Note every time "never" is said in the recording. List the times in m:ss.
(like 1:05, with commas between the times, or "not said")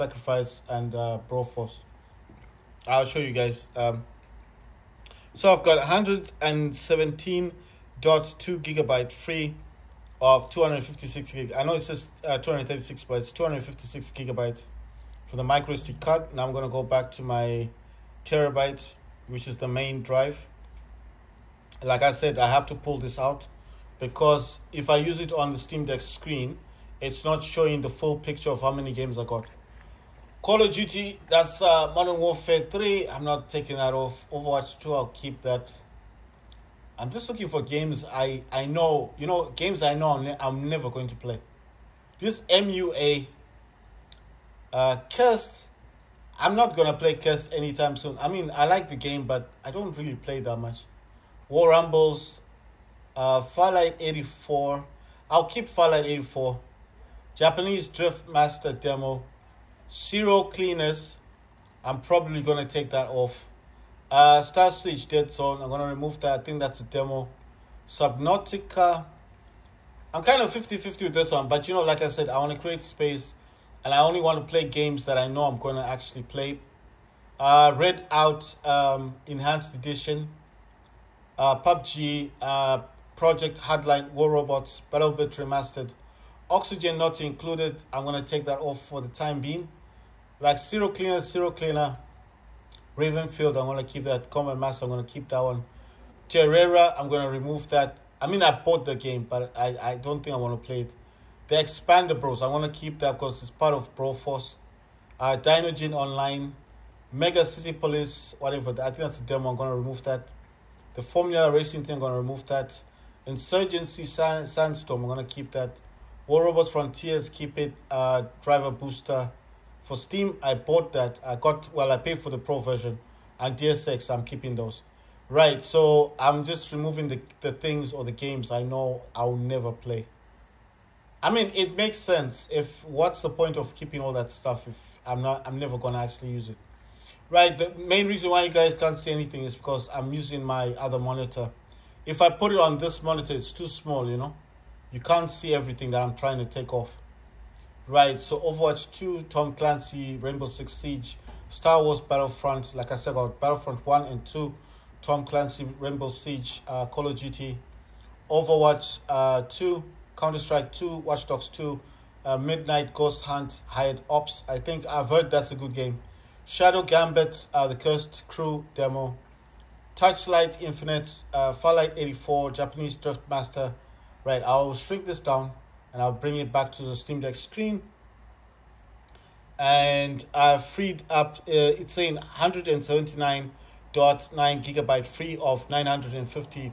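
0:40, 2:09, 2:15.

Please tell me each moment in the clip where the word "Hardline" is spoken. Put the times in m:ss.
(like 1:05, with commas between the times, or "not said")
1:23.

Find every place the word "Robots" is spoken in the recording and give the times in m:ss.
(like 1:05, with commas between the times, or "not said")
1:24, 1:56.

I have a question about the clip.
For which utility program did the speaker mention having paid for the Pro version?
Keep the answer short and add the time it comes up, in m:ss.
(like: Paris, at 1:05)
Driver Booster, at 1:58.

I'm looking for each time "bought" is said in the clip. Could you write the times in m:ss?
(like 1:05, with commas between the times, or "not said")
1:38, 2:00.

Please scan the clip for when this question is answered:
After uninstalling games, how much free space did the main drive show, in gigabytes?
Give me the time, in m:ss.
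3:02.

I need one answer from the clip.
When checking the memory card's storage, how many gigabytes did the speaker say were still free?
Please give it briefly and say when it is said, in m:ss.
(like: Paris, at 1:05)
117.2 gigabytes, at 0:05.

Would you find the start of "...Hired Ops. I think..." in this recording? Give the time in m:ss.
2:43.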